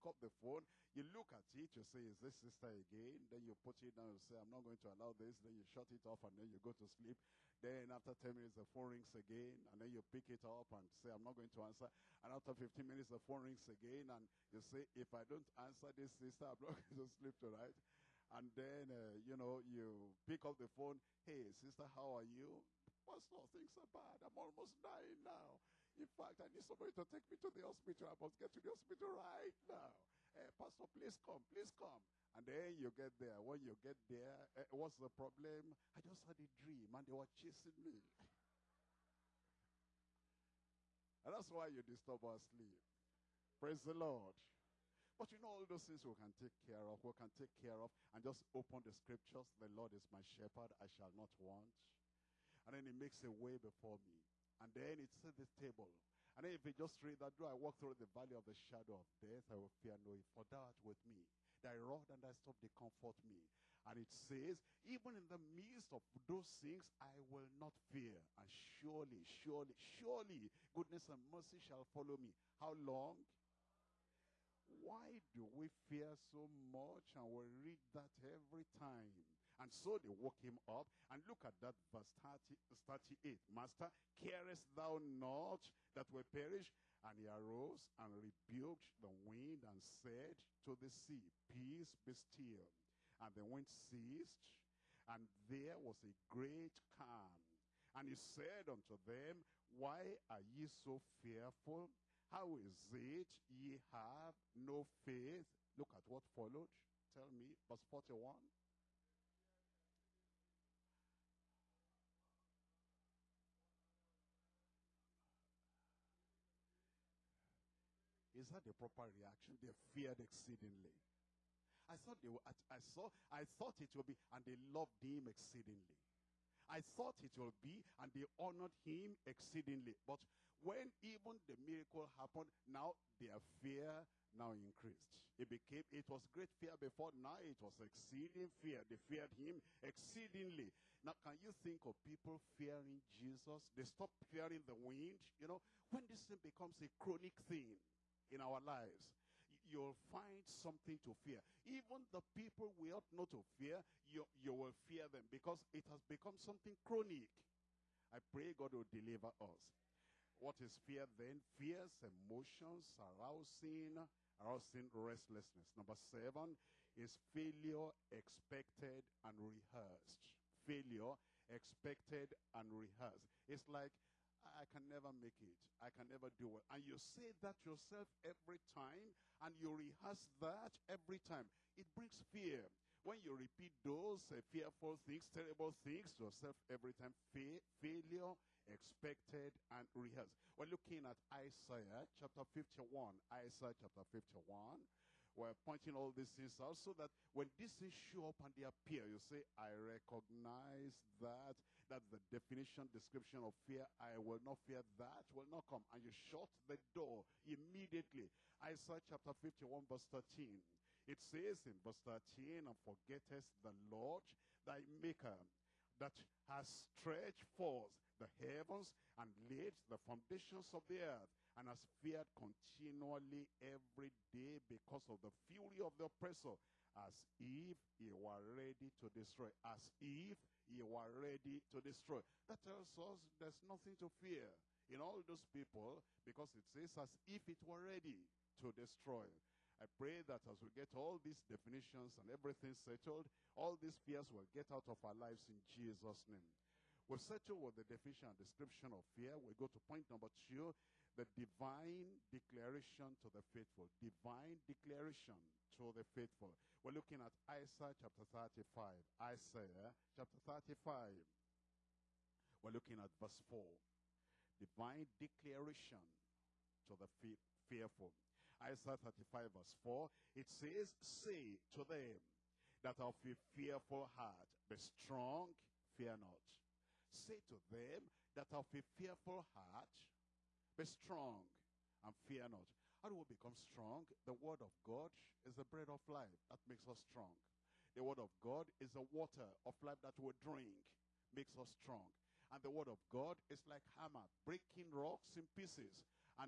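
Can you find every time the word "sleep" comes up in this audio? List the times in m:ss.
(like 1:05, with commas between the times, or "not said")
0:06, 0:17, 0:42.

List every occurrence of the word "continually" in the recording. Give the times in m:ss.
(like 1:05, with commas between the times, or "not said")
3:42.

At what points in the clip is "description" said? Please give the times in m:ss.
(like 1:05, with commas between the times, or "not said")
3:22, 4:08.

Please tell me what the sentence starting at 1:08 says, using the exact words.
And surely, surely, surely, goodness and mercy shall follow me.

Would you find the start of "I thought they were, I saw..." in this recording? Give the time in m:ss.
2:01.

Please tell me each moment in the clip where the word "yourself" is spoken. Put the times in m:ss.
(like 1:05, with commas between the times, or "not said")
2:57, 3:06.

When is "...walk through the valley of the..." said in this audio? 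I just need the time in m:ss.
0:57.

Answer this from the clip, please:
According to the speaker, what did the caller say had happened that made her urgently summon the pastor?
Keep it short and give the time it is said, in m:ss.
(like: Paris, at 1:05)
a dream, at 0:35.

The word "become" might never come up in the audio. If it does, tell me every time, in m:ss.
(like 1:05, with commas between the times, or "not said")
2:26, 2:36, 4:43.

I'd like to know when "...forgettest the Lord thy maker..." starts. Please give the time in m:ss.
3:32.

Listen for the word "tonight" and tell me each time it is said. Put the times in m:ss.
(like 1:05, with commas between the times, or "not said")
0:17.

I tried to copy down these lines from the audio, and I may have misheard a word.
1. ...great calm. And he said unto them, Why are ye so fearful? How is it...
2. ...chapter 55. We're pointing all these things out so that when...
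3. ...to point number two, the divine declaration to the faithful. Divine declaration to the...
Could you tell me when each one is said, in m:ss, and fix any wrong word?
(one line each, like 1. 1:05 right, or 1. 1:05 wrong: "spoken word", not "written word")
1. 1:36 right
2. 3:13 wrong: "51", not "55"
3. 4:09 right.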